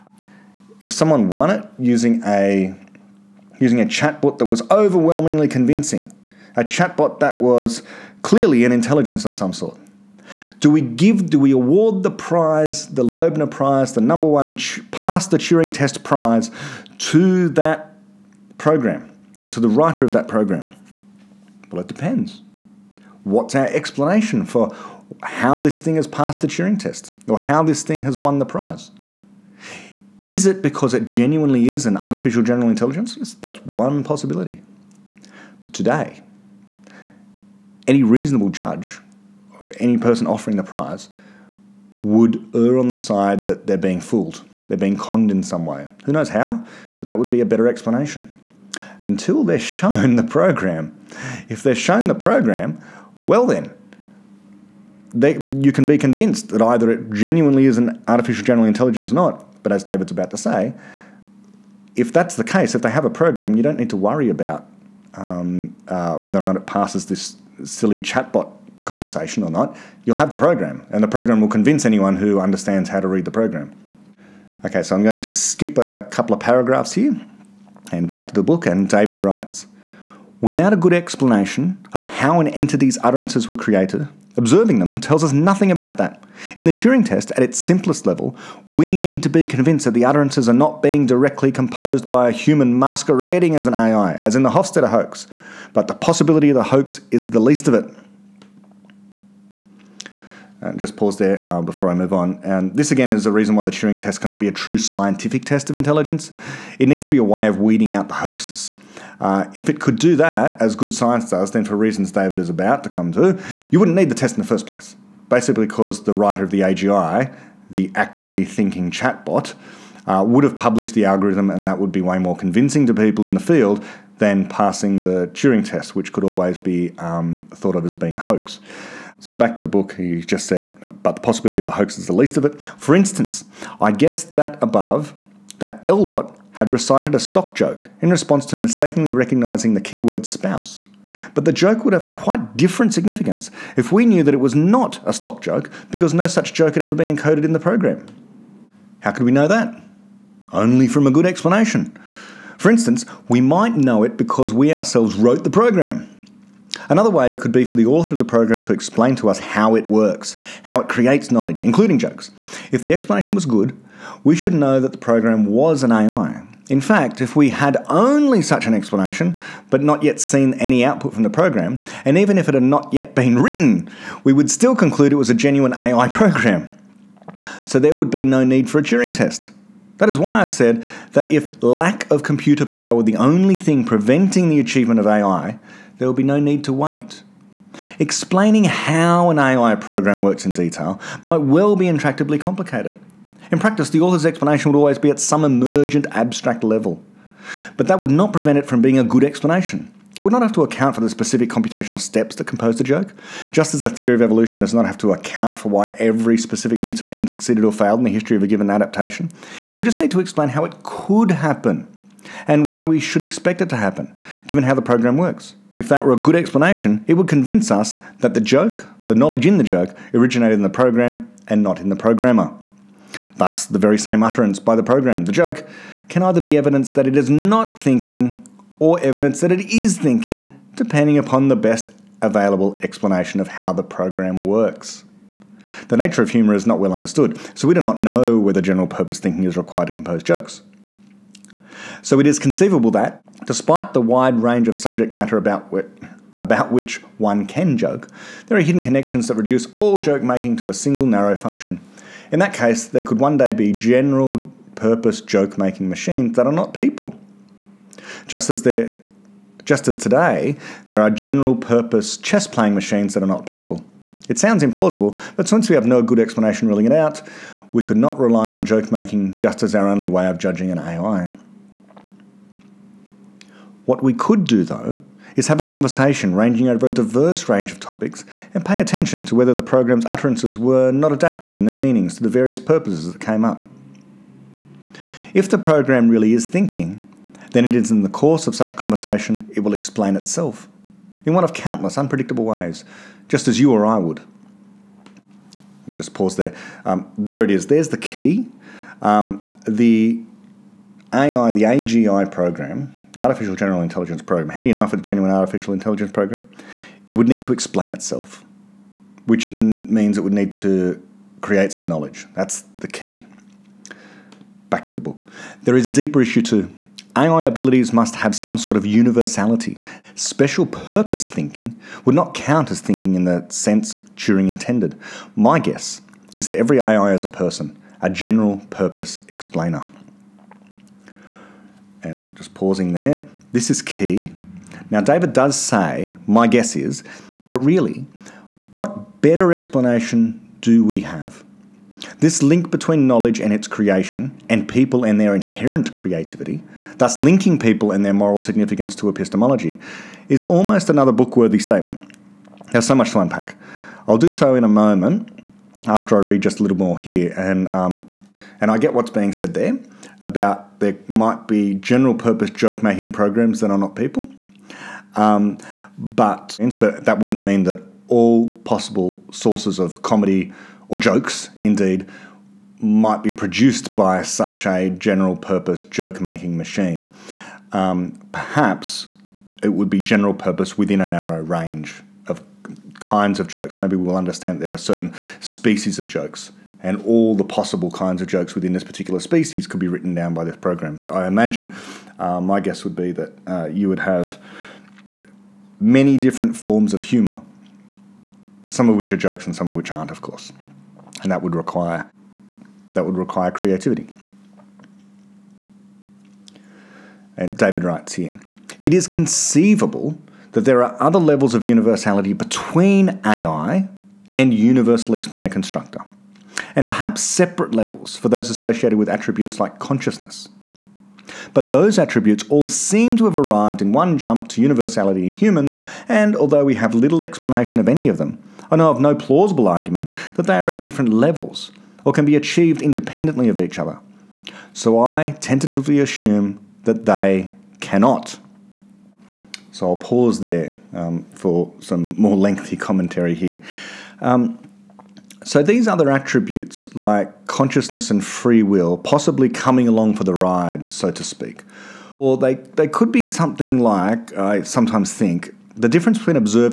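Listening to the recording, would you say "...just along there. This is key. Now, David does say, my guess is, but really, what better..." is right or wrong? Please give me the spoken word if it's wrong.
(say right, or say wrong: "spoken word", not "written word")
wrong: "pausing", not "along".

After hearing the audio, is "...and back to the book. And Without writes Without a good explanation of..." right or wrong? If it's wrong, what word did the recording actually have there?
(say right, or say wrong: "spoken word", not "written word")
wrong: "David", not "Without".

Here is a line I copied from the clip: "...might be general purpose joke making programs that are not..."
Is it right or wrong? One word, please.
right.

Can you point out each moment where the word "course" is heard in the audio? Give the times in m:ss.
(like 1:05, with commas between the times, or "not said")
4:48, 6:40.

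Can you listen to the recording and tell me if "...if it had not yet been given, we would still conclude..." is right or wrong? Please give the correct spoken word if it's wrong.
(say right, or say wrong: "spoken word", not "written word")
wrong: "written", not "given".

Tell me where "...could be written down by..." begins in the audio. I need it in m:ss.
6:29.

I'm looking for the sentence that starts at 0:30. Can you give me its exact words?
Is it because it genuinely is an artificial general intelligence?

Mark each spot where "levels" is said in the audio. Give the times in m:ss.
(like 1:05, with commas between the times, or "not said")
1:28, 3:16, 6:51, 6:57, 7:11.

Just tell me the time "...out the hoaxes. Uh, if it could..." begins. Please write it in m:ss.
1:47.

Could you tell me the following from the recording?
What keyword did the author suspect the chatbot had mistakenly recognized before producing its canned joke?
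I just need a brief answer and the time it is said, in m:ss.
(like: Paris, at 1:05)
spouse, at 2:20.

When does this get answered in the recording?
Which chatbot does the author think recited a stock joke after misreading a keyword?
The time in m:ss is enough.
2:15.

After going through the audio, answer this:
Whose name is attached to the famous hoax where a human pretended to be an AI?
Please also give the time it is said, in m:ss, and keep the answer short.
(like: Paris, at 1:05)
Hofstadter, at 1:34.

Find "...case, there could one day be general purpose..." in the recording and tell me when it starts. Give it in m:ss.
4:12.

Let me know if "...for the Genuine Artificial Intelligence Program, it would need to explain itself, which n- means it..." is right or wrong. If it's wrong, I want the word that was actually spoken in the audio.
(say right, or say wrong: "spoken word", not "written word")
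right.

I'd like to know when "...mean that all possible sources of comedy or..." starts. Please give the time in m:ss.
6:07.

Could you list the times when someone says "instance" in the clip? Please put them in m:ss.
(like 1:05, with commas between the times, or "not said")
2:12, 2:32.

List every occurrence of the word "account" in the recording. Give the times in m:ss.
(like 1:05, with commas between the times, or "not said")
3:20, 3:25.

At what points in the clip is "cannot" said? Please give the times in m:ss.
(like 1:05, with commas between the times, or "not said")
1:44, 7:17.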